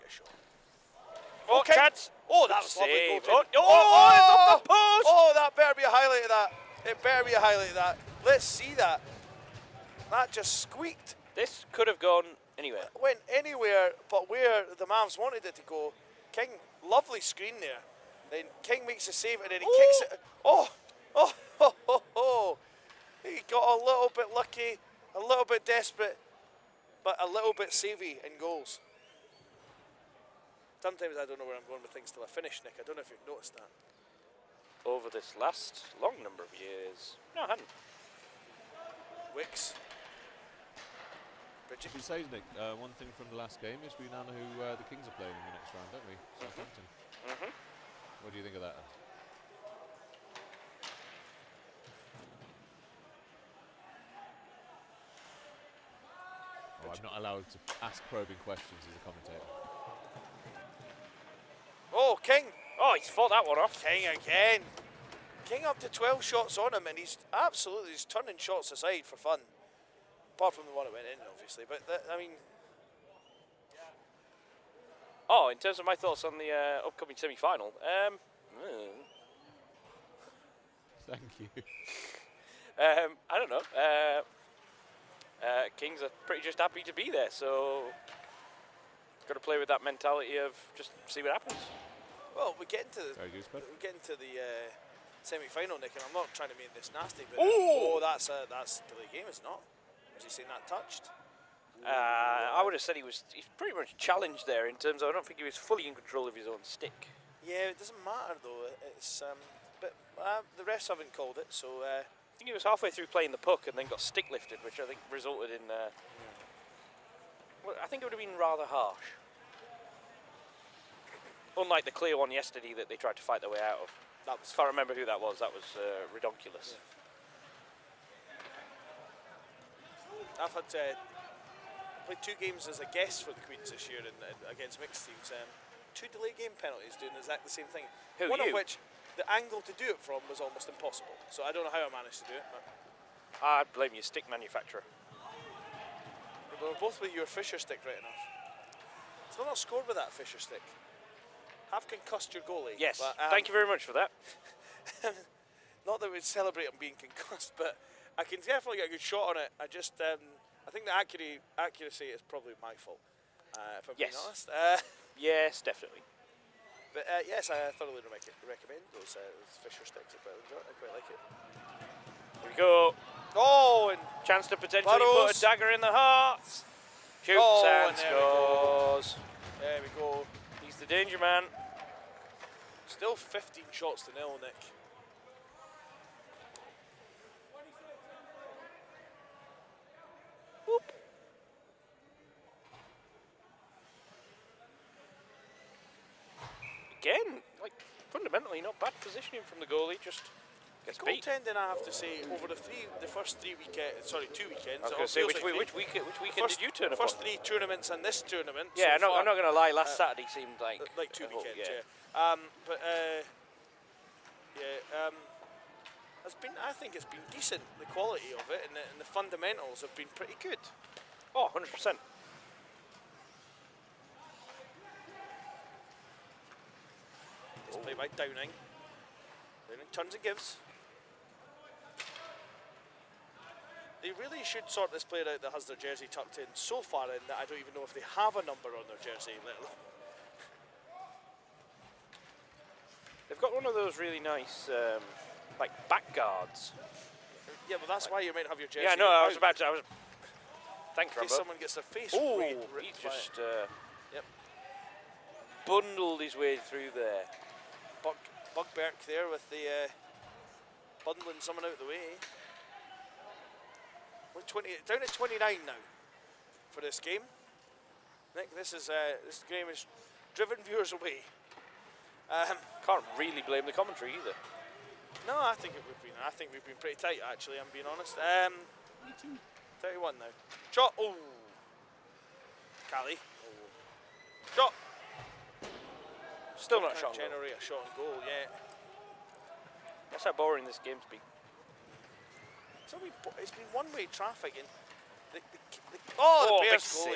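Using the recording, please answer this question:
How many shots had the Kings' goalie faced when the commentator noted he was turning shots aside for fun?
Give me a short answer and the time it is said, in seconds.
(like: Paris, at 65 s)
12, at 65 s.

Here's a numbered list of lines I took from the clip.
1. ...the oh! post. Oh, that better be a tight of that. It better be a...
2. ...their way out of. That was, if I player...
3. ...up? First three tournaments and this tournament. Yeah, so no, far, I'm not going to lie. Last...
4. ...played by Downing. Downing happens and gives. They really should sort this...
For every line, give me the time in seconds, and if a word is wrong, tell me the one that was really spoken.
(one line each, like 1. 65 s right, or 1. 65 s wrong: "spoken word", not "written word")
1. 4 s wrong: "highlight", not "tight"
2. 123 s wrong: "remember", not "player"
3. 206 s right
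4. 227 s wrong: "turns", not "happens".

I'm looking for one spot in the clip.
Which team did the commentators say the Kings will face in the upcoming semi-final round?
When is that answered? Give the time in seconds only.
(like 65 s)
46 s.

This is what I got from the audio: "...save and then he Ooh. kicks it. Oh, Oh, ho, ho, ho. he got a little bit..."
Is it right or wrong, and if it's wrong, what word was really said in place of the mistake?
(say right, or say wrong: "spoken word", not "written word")
right.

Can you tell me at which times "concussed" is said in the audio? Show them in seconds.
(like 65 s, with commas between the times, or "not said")
151 s, 156 s.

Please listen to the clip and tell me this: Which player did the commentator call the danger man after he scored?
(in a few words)
Burrows.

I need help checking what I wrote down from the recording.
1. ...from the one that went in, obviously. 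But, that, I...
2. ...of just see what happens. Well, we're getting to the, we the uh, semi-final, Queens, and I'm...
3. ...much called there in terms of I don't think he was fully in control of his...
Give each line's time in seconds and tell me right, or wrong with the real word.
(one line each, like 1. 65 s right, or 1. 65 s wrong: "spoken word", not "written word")
1. 70 s right
2. 90 s wrong: "Nick", not "Queens"
3. 103 s wrong: "challenged", not "called".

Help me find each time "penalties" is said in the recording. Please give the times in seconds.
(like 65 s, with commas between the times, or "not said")
136 s.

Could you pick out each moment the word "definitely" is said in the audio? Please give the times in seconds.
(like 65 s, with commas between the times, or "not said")
158 s, 165 s.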